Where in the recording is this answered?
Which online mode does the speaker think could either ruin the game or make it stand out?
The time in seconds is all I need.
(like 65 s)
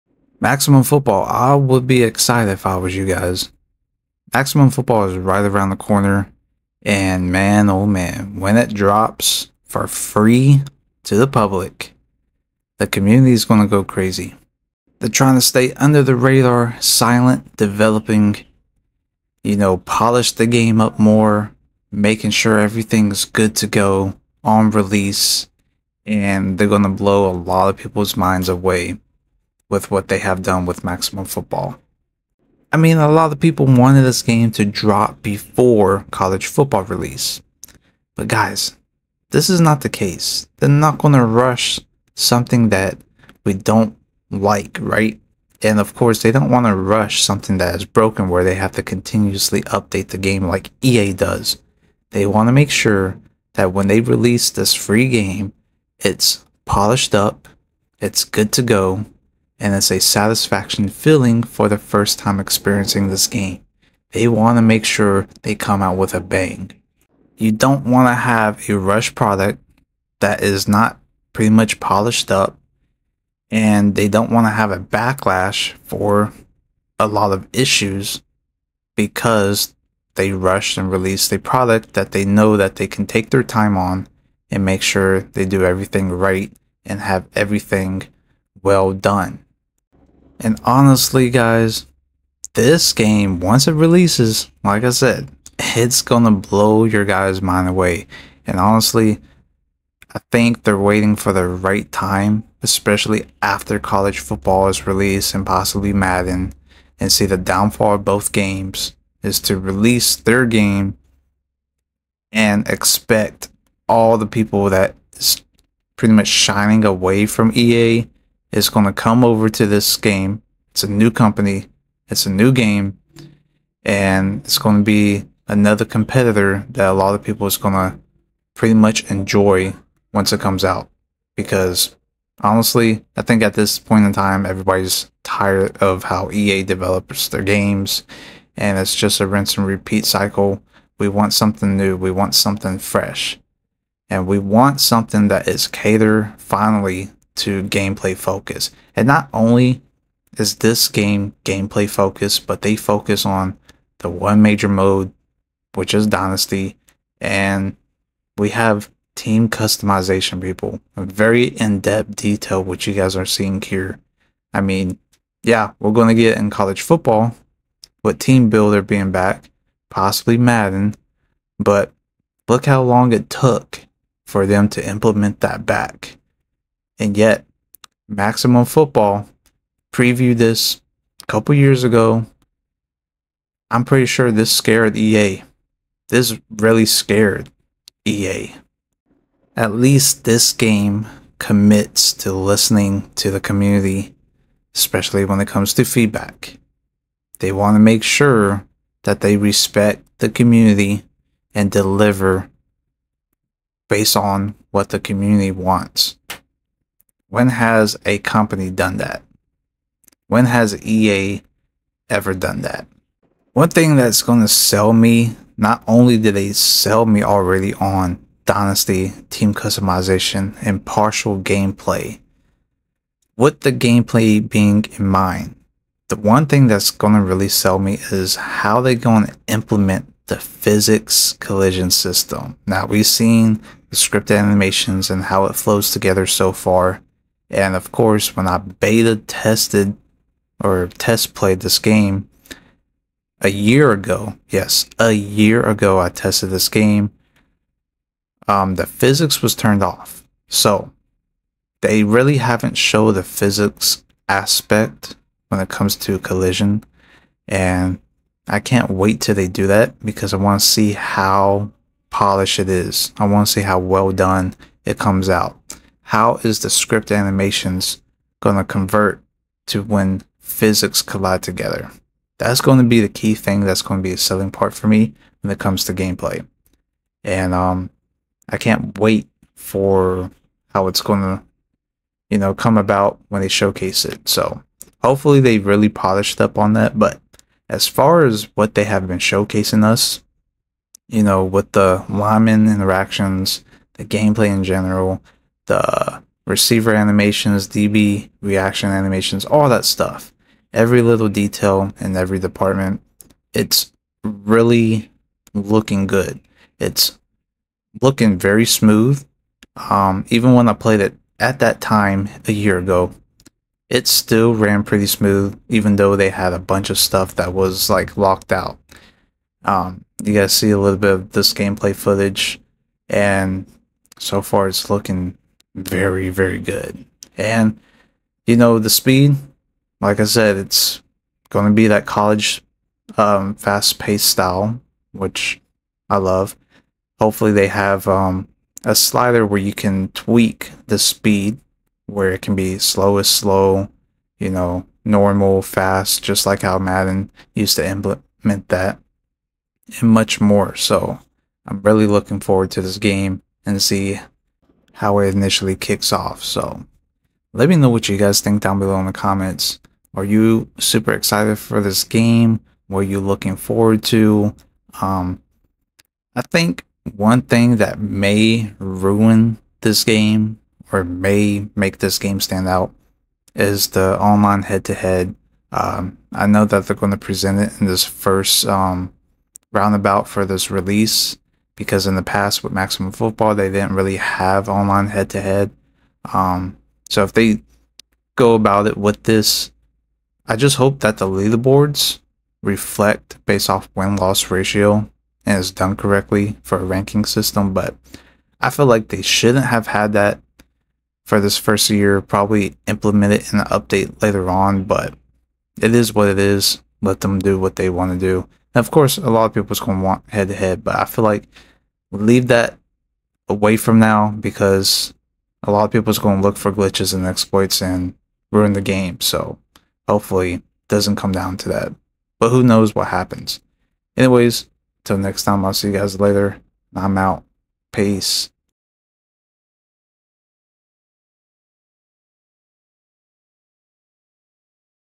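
374 s.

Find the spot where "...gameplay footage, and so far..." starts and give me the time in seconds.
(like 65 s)
321 s.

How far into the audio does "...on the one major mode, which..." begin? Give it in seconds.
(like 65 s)
153 s.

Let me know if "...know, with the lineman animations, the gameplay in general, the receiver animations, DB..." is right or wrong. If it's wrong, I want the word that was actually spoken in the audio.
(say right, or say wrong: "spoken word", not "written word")
wrong: "interactions", not "animations".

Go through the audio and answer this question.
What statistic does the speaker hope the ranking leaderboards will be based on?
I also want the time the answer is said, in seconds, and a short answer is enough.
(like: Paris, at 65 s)
win loss ratio, at 393 s.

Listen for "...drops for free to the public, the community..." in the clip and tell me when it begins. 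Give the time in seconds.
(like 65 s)
8 s.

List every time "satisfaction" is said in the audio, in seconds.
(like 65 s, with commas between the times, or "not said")
59 s.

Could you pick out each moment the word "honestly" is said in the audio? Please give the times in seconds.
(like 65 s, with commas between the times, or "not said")
90 s, 98 s, 132 s.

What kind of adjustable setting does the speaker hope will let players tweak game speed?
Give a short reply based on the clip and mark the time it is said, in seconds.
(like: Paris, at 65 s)
a slider, at 338 s.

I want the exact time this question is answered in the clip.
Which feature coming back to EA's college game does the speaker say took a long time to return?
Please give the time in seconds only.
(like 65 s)
168 s.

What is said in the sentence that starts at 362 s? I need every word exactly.
What are you looking forward to?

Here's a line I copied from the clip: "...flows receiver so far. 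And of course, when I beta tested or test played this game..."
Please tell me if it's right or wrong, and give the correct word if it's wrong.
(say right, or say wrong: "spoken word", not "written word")
wrong: "together", not "receiver".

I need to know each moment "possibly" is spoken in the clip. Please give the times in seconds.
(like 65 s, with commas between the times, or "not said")
105 s, 169 s.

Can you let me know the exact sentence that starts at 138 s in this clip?
And it's just a rinse and repeat cycle.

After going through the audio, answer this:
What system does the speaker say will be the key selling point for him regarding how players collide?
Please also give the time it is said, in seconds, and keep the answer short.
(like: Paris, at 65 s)
physics collision system, at 230 s.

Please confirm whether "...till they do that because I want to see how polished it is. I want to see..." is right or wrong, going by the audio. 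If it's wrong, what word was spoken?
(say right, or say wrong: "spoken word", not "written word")
right.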